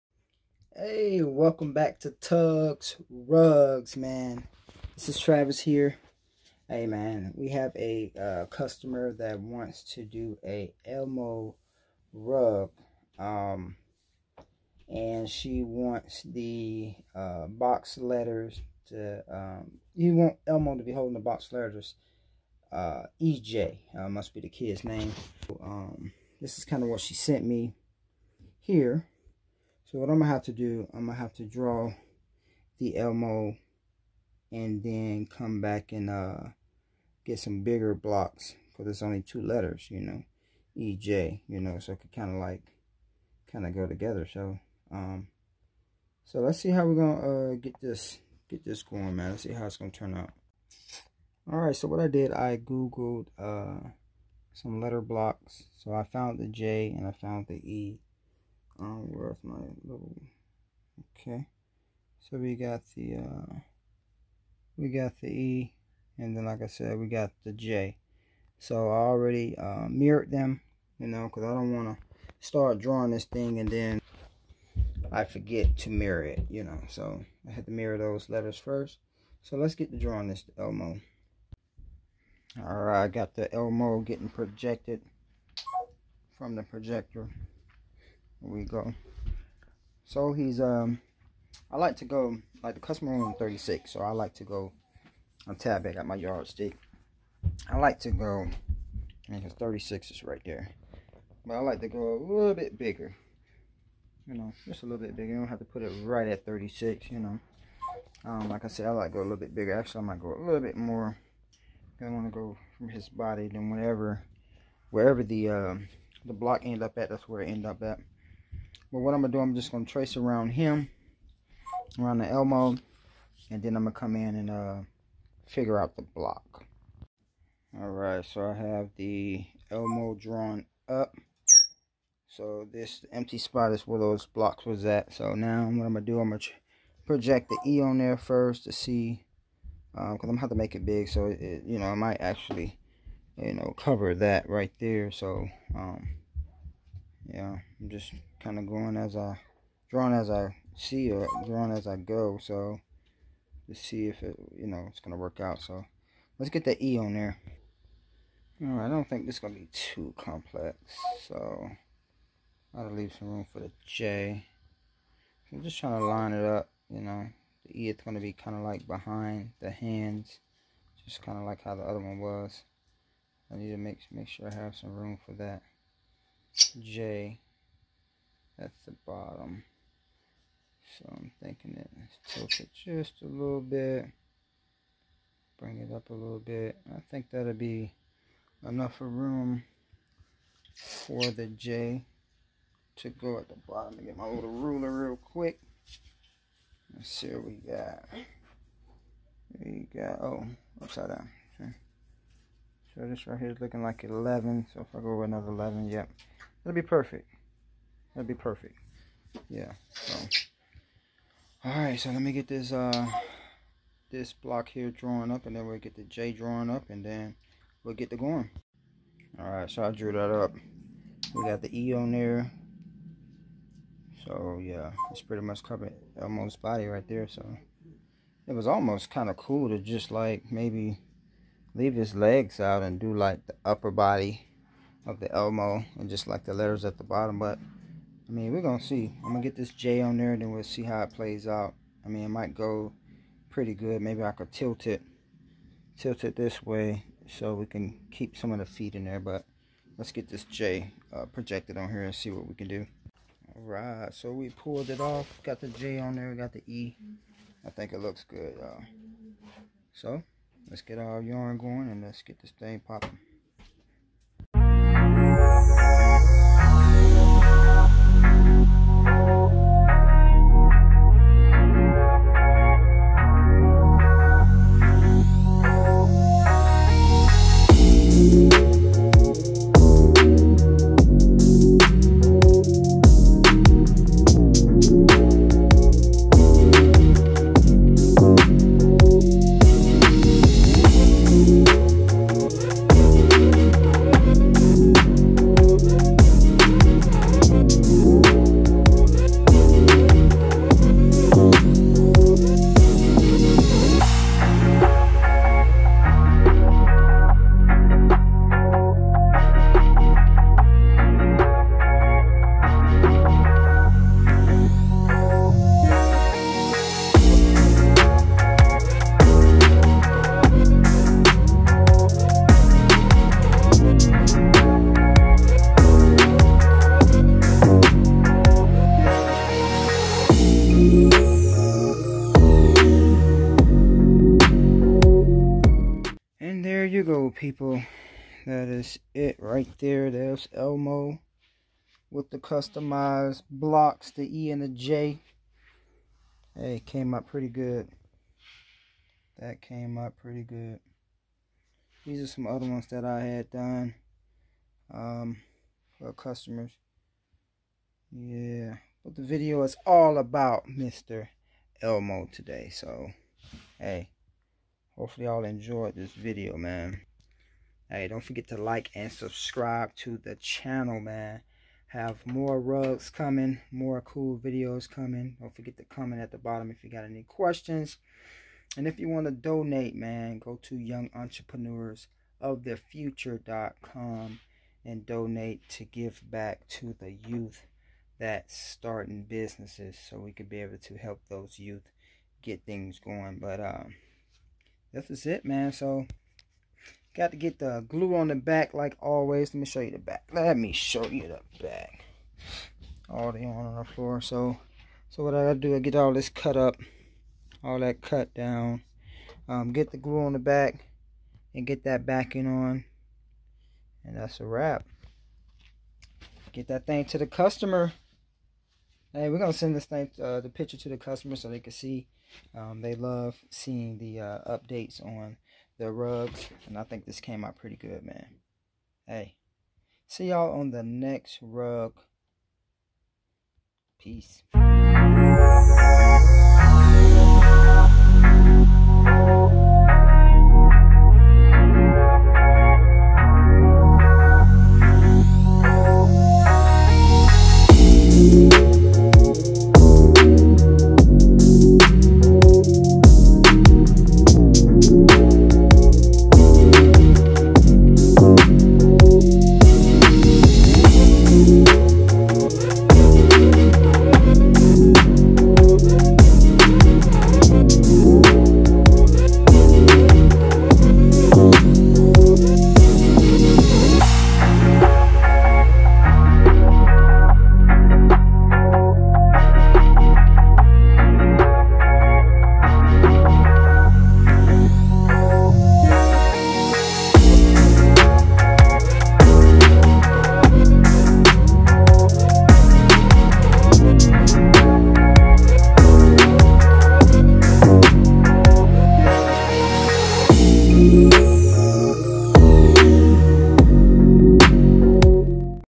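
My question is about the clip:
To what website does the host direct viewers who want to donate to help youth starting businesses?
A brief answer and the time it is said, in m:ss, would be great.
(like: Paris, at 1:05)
youngentrepreneursofthefuture.com, at 6:20.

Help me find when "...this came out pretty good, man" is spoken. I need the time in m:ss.
7:07.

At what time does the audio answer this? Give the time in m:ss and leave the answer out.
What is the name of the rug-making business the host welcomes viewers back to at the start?
0:02.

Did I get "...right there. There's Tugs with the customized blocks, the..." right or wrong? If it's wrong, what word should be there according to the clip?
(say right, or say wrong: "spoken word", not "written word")
wrong: "Elmo", not "Tugs".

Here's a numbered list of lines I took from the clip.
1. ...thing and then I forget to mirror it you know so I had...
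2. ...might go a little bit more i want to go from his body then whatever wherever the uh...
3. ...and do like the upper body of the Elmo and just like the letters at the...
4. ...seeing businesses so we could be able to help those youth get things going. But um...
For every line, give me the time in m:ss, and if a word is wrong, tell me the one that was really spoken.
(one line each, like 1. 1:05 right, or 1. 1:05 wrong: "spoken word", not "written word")
1. 1:13 right
2. 1:50 right
3. 3:52 right
4. 6:28 wrong: "starting", not "seeing".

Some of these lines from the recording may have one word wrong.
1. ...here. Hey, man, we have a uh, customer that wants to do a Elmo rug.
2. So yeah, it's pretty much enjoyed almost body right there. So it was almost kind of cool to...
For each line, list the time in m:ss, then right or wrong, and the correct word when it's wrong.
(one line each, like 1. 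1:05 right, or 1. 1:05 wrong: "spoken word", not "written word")
1. 0:05 right
2. 3:44 wrong: "covered", not "enjoyed".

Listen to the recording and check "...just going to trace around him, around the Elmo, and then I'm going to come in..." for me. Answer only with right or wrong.
right.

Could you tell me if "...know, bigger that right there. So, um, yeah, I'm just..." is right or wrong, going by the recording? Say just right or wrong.
wrong.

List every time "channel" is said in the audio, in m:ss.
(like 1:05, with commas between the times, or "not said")
6:10.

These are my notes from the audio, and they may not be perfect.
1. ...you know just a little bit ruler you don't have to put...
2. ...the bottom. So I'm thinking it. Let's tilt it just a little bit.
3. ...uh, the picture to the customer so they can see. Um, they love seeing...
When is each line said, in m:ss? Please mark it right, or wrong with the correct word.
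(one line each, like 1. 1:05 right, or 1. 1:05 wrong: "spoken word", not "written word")
1. 1:44 wrong: "bigger", not "ruler"
2. 2:58 right
3. 7:00 right.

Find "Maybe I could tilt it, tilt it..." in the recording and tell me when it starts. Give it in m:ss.
4:04.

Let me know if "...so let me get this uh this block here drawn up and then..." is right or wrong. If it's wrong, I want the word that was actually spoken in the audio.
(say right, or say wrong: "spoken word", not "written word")
right.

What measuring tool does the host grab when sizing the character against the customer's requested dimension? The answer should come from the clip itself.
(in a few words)
yardstick.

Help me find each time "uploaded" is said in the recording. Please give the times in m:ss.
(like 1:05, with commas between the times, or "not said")
not said.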